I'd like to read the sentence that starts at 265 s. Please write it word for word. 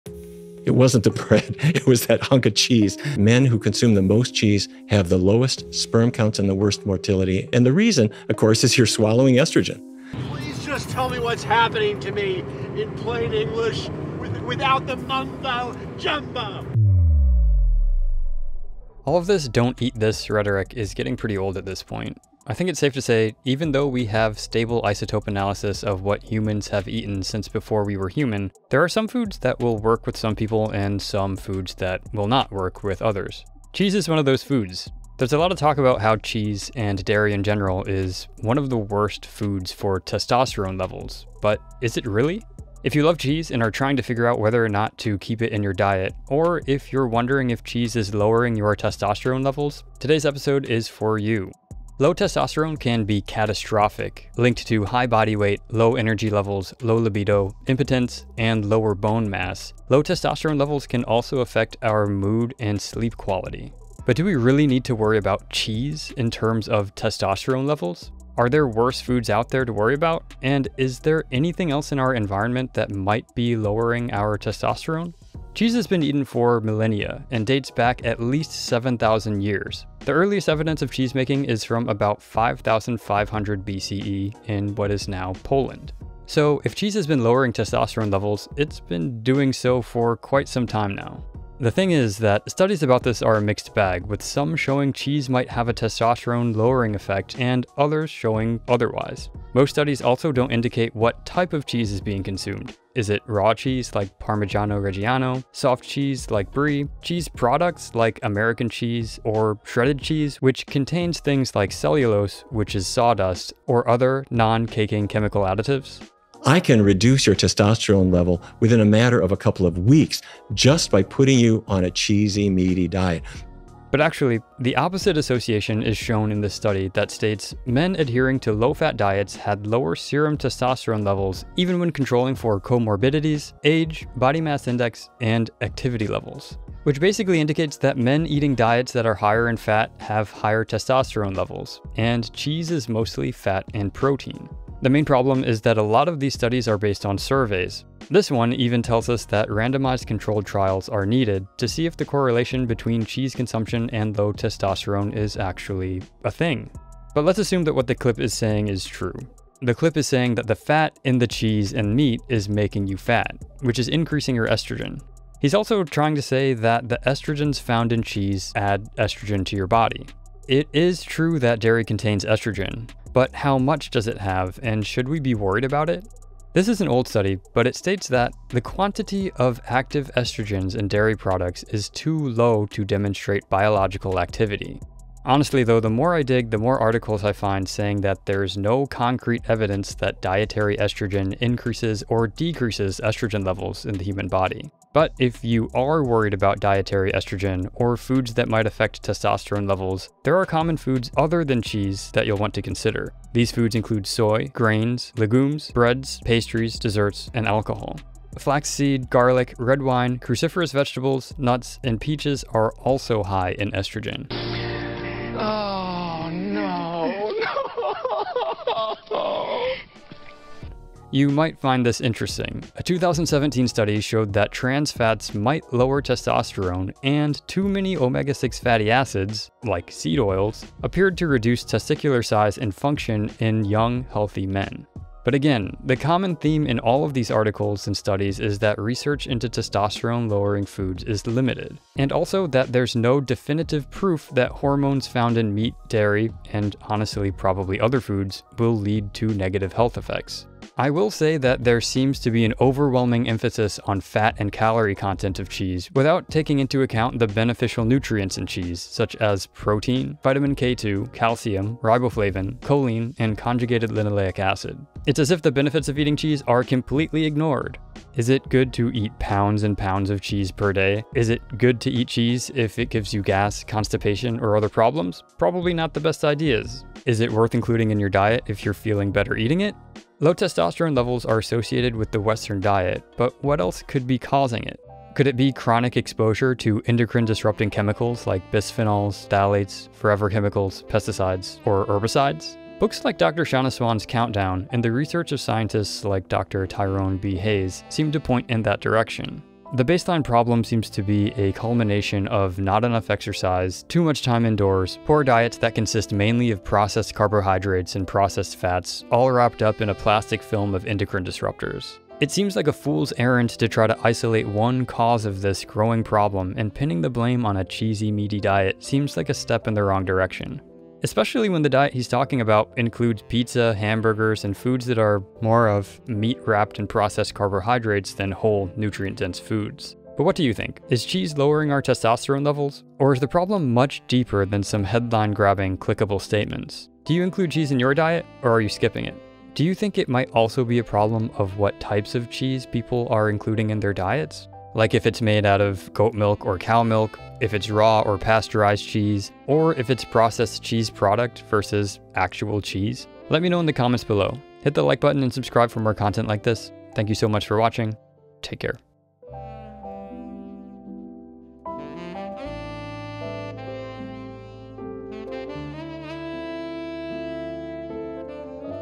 It's as if the benefits of eating cheese are completely ignored.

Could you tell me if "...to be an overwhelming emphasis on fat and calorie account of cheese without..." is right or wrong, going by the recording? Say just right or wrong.
wrong.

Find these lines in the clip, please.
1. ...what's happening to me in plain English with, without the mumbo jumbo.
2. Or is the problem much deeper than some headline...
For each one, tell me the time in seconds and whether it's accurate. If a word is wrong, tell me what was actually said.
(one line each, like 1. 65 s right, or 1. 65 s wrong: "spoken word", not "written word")
1. 11 s right
2. 332 s right.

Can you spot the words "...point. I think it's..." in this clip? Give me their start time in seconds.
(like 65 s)
21 s.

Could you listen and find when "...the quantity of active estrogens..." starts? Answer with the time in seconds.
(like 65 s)
178 s.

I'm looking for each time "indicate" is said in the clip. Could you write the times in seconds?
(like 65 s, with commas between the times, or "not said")
100 s, 137 s.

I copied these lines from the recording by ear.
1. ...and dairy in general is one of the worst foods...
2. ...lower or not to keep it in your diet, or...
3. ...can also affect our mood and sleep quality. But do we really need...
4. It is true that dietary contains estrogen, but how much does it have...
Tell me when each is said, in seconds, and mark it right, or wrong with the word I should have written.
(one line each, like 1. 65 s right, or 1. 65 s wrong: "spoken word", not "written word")
1. 36 s right
2. 44 s wrong: "whether", not "lower"
3. 60 s right
4. 170 s wrong: "dairy", not "dietary".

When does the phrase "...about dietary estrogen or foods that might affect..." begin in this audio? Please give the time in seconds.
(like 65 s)
196 s.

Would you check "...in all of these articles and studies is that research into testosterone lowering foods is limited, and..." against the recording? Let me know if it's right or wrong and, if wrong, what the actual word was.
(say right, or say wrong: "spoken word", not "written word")
right.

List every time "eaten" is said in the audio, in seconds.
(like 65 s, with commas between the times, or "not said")
26 s, 76 s.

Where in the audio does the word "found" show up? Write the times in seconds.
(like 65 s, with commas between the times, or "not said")
167 s, 245 s.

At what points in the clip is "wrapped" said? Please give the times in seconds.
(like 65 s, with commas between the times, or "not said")
309 s, 326 s.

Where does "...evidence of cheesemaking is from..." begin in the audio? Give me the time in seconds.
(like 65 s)
80 s.